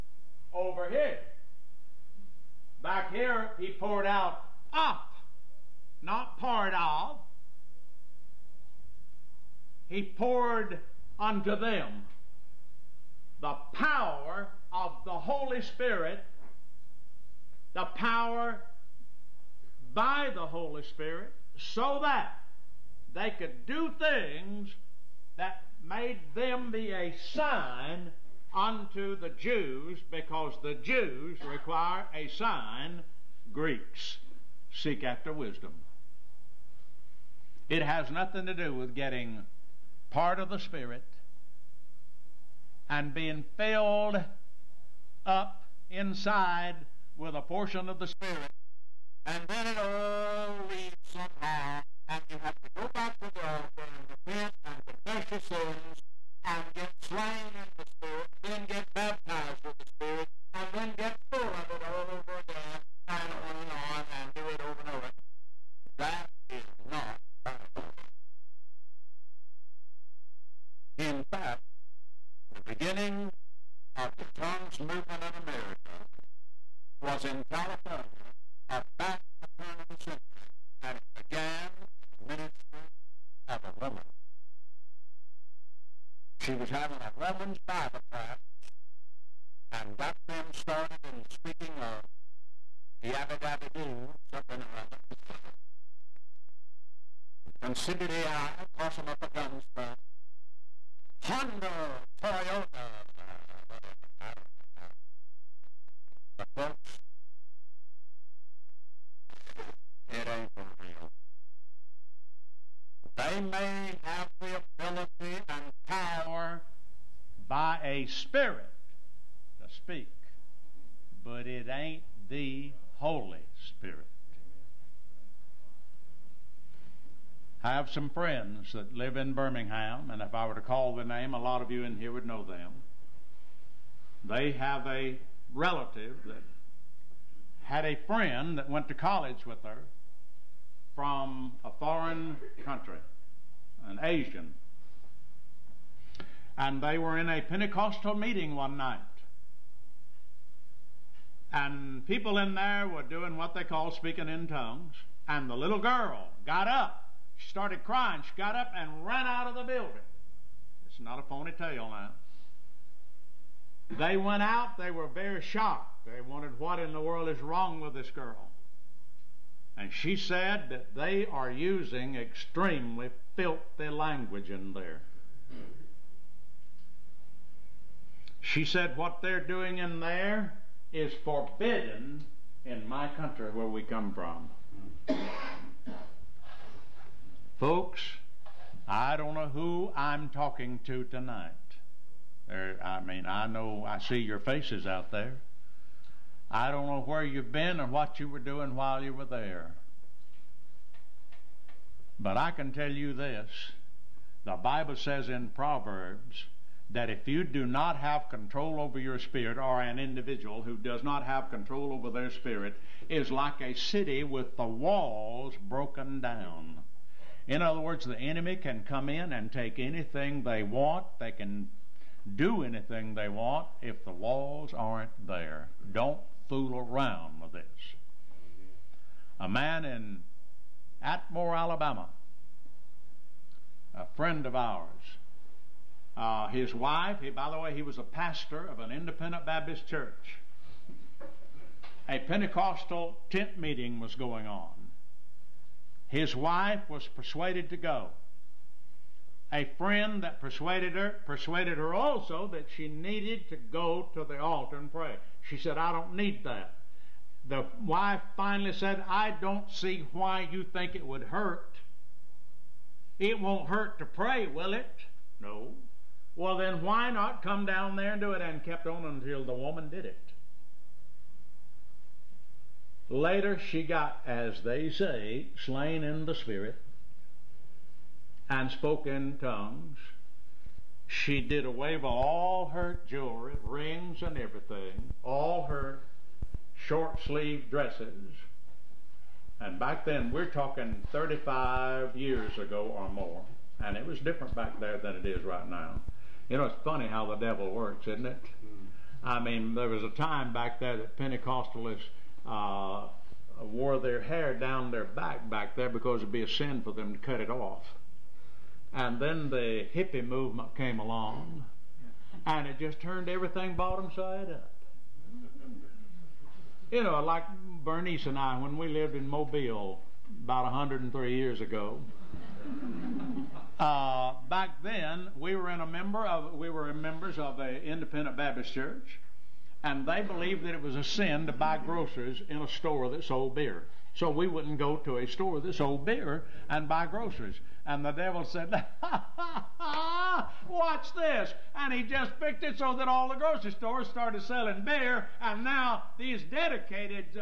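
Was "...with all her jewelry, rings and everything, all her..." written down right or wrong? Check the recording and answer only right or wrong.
right.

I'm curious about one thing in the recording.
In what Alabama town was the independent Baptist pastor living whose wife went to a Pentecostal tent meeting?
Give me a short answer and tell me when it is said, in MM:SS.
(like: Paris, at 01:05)
Atmore, at 03:51.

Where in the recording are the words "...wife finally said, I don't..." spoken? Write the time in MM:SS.
04:17.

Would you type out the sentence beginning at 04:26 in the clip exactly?
Well, then why not come down there and do it?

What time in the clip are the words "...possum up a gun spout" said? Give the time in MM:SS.
01:38.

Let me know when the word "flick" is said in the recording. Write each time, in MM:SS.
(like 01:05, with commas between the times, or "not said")
not said.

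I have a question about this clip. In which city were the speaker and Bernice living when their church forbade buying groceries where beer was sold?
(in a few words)
Mobile.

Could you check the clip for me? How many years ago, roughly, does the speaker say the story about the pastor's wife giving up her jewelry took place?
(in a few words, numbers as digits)
35 years.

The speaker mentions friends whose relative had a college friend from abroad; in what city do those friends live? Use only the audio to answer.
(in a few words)
Birmingham.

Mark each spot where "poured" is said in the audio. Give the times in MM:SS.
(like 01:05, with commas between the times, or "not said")
00:03, 00:10.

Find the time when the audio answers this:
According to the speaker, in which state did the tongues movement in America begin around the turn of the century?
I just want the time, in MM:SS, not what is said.
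01:17.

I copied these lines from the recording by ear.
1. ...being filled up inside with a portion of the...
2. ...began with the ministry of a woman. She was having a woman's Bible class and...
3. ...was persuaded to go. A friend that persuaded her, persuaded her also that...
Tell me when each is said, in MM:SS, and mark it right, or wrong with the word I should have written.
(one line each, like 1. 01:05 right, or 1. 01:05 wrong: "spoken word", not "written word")
1. 00:43 right
2. 01:21 right
3. 04:06 right.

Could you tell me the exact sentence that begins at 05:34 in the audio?
So we wouldn't go to a store that sold beer and buy groceries.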